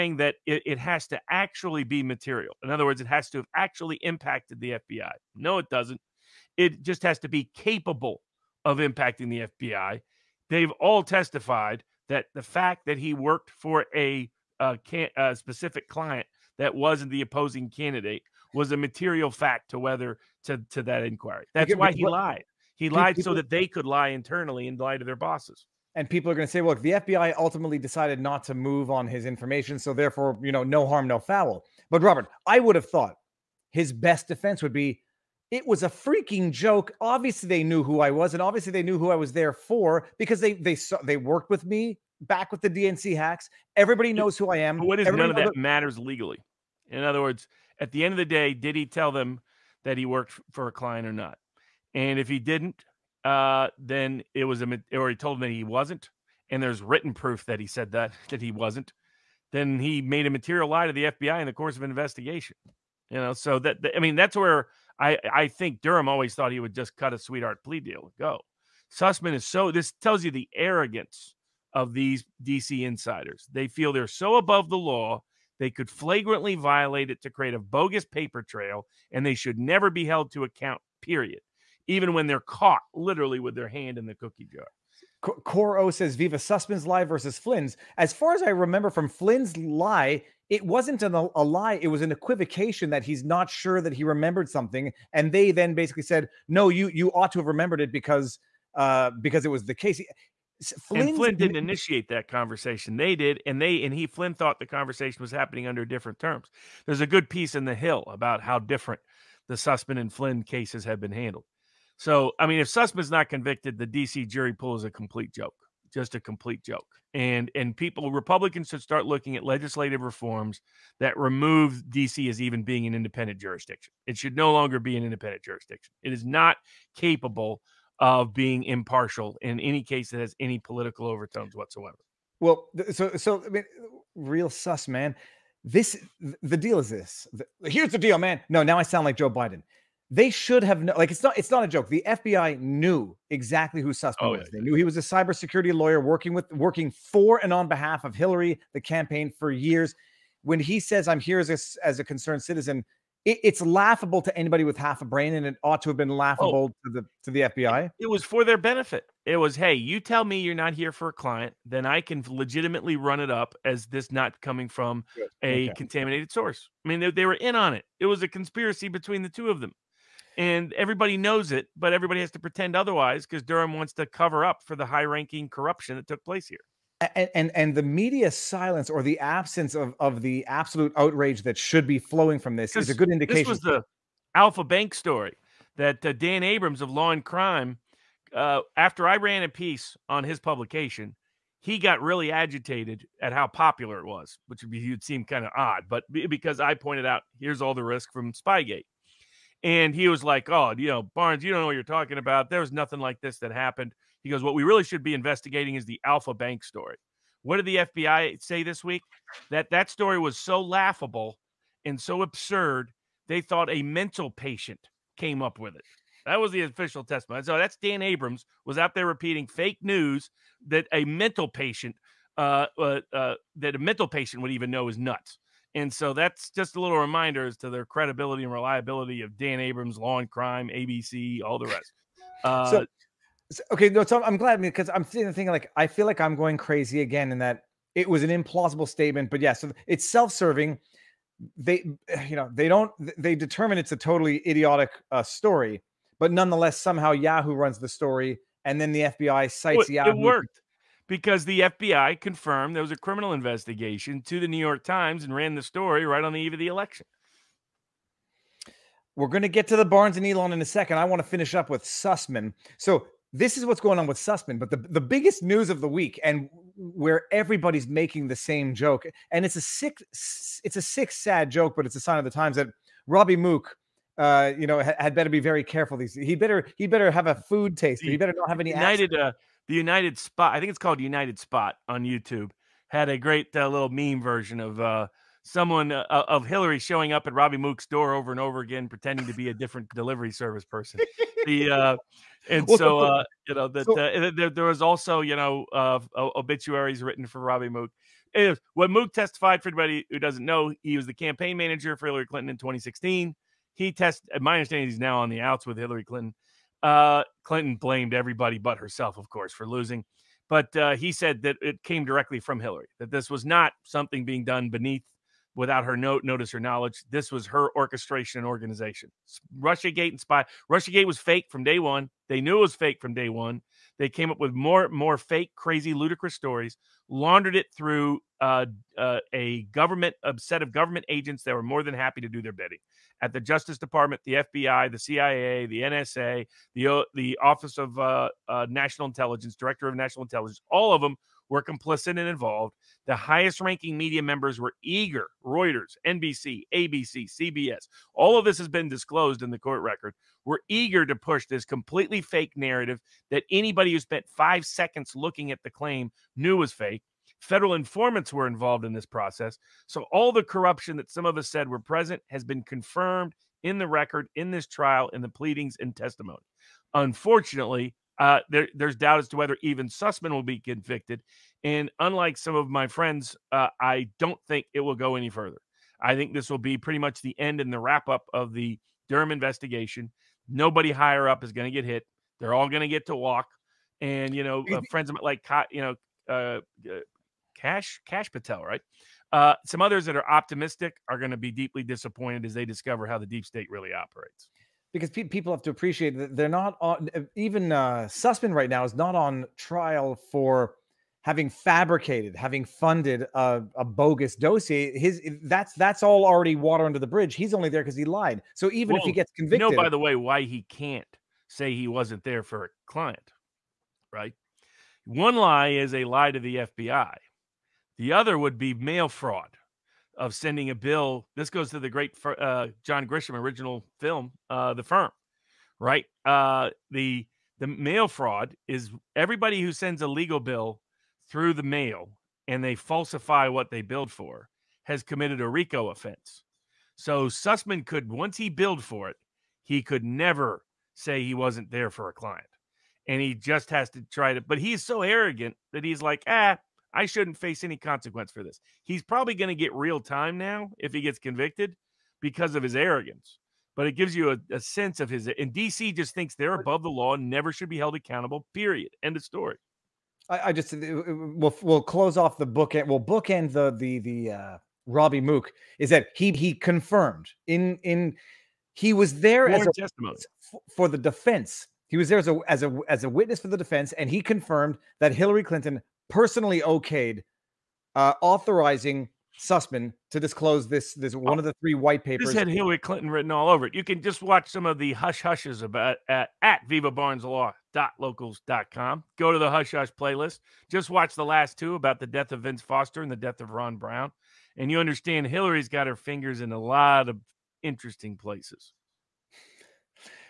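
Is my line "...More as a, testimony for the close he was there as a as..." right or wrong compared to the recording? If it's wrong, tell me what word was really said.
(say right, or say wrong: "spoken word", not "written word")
wrong: "defense", not "close".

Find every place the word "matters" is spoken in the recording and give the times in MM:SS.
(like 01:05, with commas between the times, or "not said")
00:45.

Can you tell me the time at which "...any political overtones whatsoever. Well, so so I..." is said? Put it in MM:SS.
02:10.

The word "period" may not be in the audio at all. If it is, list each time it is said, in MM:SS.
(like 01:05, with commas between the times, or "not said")
01:21, 07:38.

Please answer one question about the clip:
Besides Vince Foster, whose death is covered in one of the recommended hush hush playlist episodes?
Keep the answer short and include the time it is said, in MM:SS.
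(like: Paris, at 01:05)
Ron Brown, at 08:13.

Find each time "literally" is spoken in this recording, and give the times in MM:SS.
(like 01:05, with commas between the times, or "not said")
01:22.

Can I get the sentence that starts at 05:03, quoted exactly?
He test, my understanding, he's now on the outs with Hillary Clinton.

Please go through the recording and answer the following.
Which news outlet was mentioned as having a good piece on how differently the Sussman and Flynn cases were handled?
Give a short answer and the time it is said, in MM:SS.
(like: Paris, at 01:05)
The Hill, at 01:47.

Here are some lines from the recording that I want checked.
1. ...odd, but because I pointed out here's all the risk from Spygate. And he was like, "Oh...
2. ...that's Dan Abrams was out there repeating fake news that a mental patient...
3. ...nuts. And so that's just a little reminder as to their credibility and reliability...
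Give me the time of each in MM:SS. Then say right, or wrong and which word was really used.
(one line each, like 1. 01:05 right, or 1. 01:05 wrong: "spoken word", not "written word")
1. 03:15 right
2. 03:37 right
3. 03:44 right.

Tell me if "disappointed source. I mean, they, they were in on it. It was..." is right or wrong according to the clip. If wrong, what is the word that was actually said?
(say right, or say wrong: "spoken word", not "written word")
wrong: "contaminated", not "disappointed".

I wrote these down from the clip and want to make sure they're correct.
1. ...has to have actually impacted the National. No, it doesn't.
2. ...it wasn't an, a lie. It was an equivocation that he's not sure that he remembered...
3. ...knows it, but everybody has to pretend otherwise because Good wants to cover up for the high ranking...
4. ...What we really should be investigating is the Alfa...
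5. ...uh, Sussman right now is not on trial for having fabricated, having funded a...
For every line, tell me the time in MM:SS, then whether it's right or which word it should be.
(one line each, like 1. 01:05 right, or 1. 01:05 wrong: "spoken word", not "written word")
1. 00:03 wrong: "FBI", not "National"
2. 01:30 right
3. 02:51 wrong: "Durham", not "Good"
4. 03:24 right
5. 06:37 right.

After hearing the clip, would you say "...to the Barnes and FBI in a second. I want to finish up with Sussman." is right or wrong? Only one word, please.
wrong.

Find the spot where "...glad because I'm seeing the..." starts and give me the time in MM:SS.
03:54.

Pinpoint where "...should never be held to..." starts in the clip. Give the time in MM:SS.
01:19.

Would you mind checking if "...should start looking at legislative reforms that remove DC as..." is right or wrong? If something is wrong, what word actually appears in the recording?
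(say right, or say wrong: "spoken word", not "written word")
right.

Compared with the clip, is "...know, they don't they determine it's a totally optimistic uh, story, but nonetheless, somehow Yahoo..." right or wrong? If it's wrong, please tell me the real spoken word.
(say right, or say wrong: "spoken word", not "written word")
wrong: "idiotic", not "optimistic".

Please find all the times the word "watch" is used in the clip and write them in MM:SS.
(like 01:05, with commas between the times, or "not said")
08:04, 08:10.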